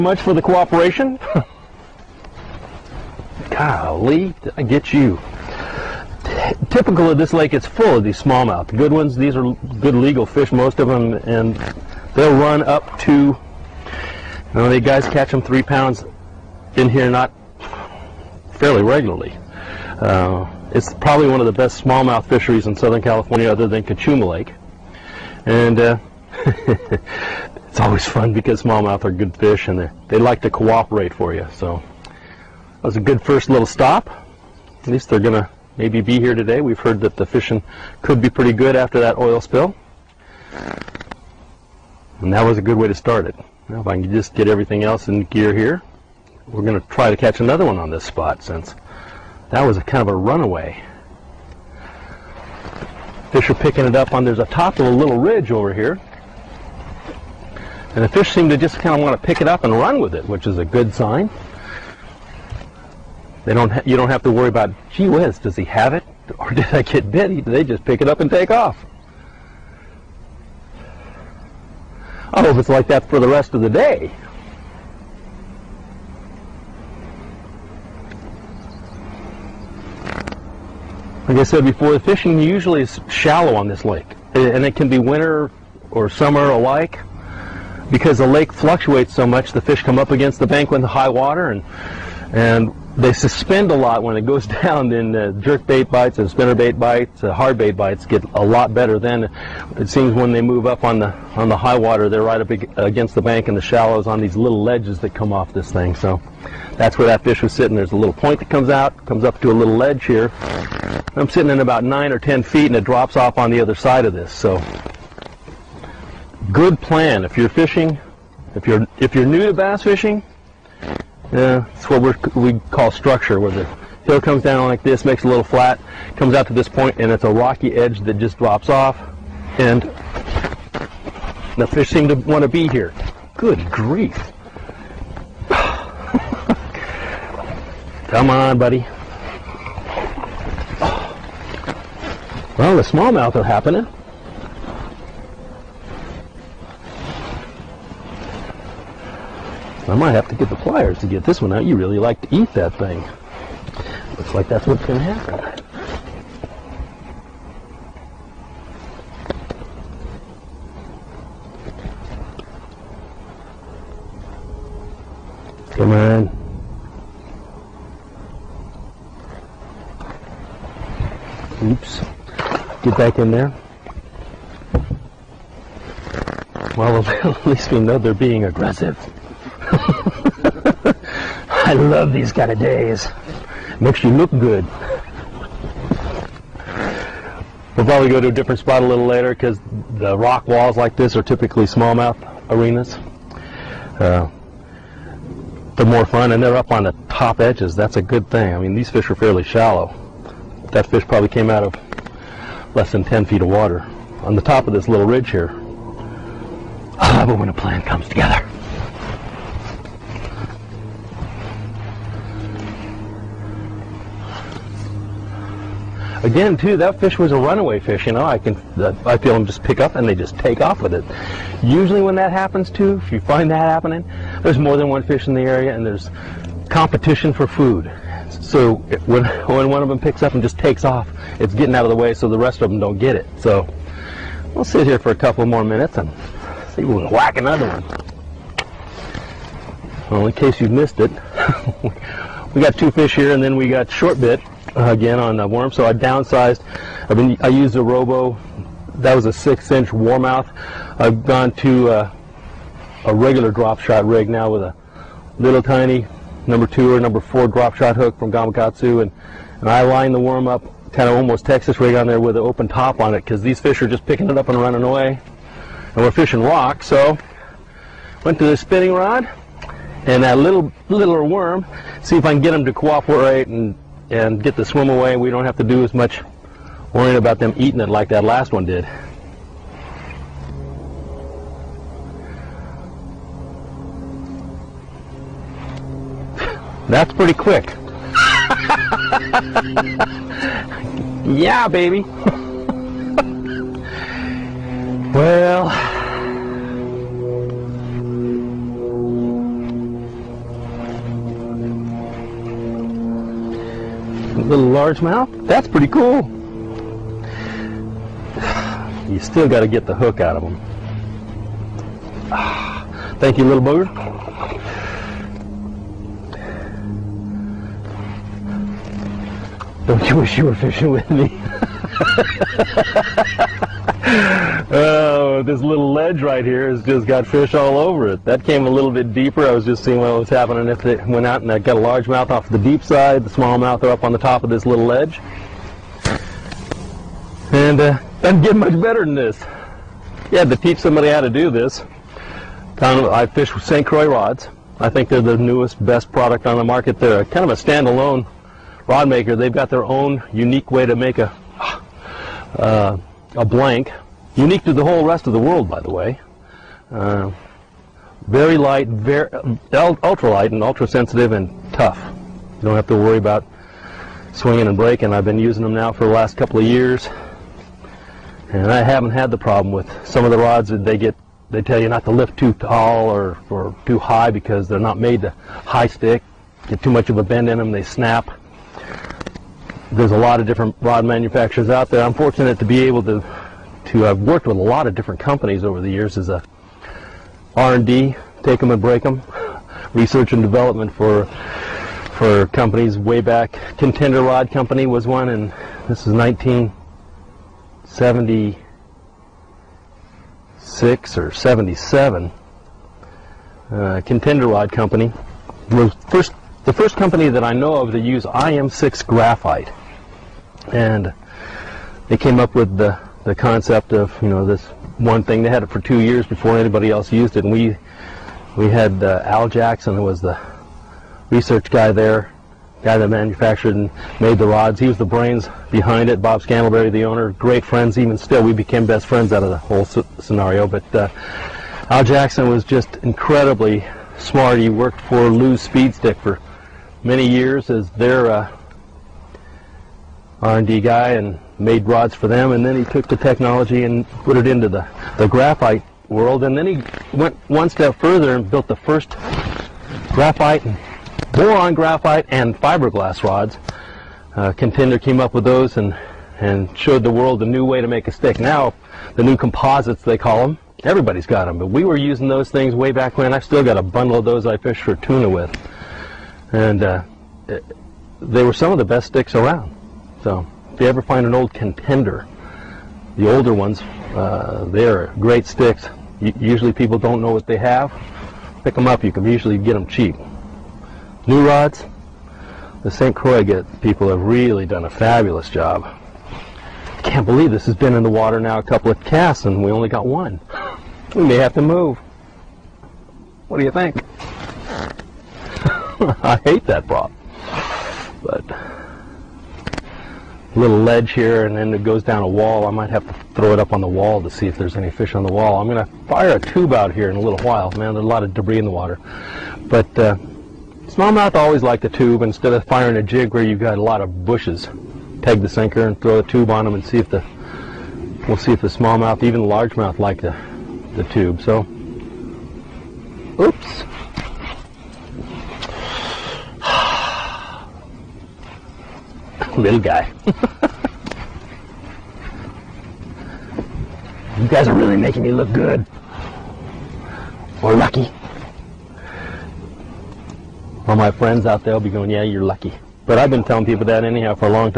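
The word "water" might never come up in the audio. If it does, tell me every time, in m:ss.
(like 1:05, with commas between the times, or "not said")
1:31, 1:41, 3:23, 8:08, 8:28.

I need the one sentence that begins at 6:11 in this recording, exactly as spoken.
They tell you not to lift too tall or, or too high because they're not made to high stick.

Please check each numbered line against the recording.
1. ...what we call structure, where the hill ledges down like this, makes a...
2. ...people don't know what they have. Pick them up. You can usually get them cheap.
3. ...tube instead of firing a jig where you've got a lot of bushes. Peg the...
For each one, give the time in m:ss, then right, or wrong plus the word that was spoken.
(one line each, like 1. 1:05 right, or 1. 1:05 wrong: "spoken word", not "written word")
1. 2:01 wrong: "comes", not "ledges"
2. 7:56 right
3. 8:31 right.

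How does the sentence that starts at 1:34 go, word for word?
Then uh, jerk bait bites and spinner bait bites, uh, hard bait bites get a lot better.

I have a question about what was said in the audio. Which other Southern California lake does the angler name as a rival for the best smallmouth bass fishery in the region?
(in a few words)
Cachuma Lake.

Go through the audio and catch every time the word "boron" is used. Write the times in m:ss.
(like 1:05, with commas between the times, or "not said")
7:31.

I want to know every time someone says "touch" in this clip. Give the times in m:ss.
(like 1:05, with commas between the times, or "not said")
not said.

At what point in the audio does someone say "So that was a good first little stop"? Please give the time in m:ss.
0:31.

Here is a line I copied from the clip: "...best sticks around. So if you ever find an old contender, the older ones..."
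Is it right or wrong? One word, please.
right.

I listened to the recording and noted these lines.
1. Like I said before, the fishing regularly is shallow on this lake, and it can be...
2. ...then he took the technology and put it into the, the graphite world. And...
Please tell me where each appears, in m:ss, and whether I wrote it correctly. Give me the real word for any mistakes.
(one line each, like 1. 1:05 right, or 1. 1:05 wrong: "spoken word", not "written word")
1. 1:21 wrong: "usually", not "regularly"
2. 7:22 right.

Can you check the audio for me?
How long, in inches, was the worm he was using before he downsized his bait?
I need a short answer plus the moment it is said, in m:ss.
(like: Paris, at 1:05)
6 inches, at 4:09.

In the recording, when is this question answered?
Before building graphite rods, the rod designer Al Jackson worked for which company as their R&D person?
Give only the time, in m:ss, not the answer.
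7:15.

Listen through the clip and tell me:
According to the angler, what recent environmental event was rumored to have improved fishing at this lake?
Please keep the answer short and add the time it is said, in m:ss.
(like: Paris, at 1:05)
oil spill, at 0:39.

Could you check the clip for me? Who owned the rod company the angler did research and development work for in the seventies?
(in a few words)
Bob Scandalberry.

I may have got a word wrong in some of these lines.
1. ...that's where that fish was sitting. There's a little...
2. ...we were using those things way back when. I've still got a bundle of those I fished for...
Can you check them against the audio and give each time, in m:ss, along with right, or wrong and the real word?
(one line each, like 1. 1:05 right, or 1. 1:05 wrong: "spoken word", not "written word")
1. 1:46 right
2. 7:41 right.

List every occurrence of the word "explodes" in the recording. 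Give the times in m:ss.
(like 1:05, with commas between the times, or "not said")
not said.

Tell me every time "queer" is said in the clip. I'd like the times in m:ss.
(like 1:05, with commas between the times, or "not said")
not said.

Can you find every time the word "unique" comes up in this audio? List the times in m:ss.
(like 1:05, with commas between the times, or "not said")
5:50, 5:54.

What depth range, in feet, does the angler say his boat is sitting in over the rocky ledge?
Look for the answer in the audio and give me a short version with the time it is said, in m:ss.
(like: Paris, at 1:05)
9 or 10 feet, at 1:51.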